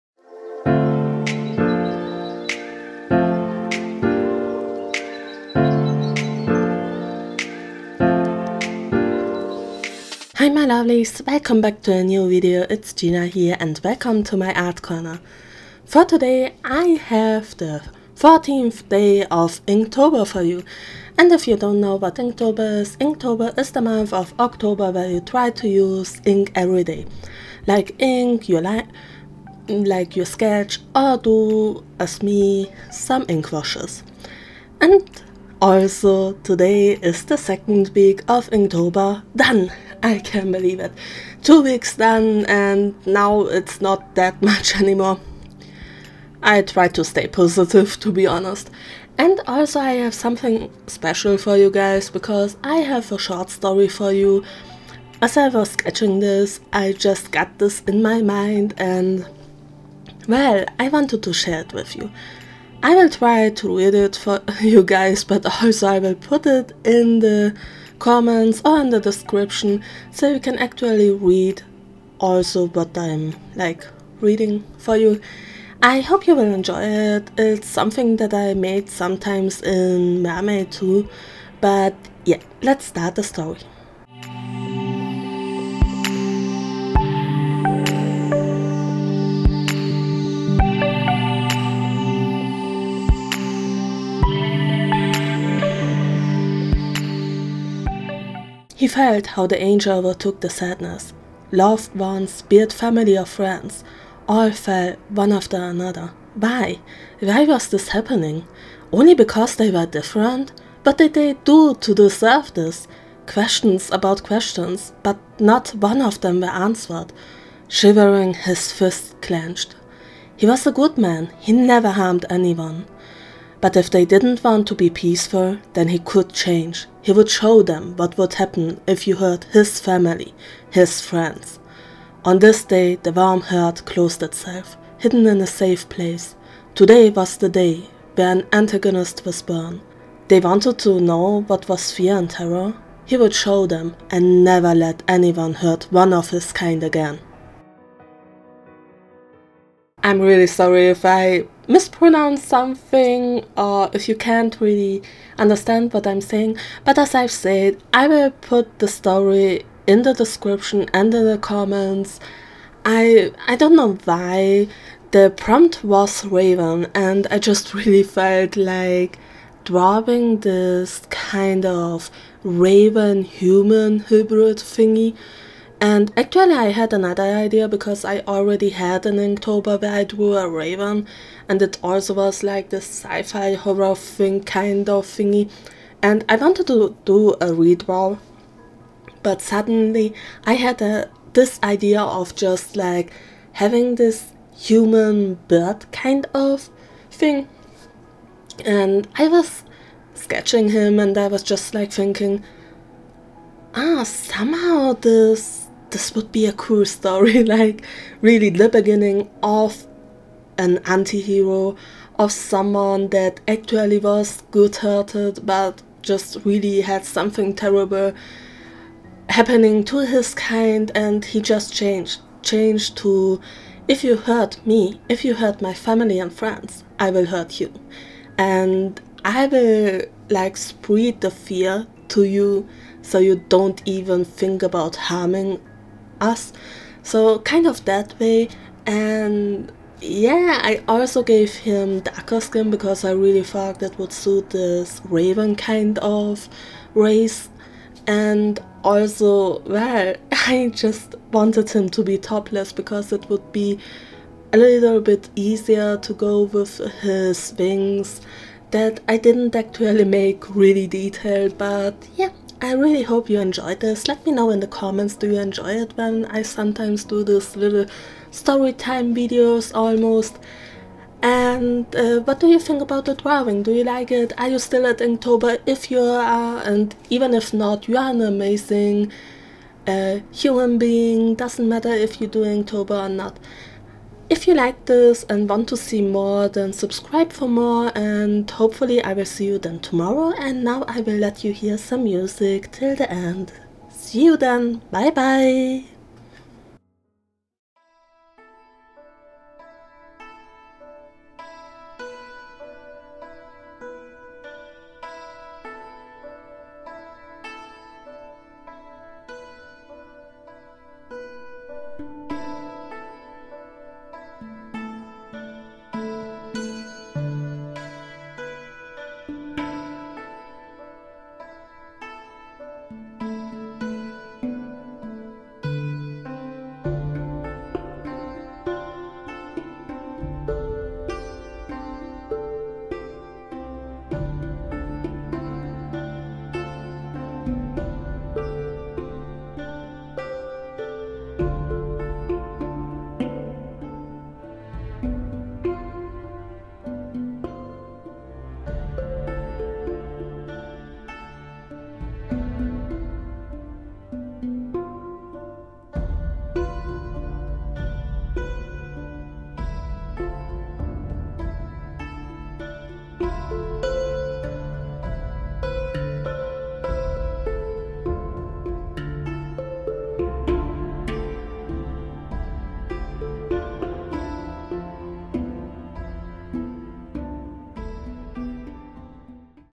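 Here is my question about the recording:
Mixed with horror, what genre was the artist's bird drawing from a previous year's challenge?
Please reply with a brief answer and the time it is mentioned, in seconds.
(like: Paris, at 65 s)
sci-fi, at 182 s.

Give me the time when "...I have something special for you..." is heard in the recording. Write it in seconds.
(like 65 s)
49 s.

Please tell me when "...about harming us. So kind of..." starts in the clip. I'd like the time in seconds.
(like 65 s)
234 s.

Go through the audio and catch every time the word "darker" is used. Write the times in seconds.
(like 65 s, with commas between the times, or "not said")
241 s.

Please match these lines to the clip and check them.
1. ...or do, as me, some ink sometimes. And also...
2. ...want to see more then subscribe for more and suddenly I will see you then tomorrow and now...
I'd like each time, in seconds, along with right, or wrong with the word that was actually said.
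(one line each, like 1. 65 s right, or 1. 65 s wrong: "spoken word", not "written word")
1. 30 s wrong: "washes", not "sometimes"
2. 285 s wrong: "hopefully", not "suddenly".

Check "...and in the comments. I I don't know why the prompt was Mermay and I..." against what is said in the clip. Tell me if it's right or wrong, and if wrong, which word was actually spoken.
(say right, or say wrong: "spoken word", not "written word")
wrong: "Raven", not "Mermay".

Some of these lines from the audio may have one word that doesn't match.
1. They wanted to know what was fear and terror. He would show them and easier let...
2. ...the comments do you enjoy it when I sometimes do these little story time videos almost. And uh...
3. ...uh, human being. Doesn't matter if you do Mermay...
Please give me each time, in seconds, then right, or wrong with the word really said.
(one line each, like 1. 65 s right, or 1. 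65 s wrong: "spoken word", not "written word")
1. 140 s wrong: "never", not "easier"
2. 264 s right
3. 279 s wrong: "Inktober", not "Mermay".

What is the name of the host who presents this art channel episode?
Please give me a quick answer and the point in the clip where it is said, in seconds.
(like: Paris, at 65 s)
Gina, at 12 s.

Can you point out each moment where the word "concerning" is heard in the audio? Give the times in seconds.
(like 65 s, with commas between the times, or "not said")
not said.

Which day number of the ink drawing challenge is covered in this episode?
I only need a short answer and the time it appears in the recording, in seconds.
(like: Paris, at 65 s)
14th, at 18 s.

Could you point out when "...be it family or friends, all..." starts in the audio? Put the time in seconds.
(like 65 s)
102 s.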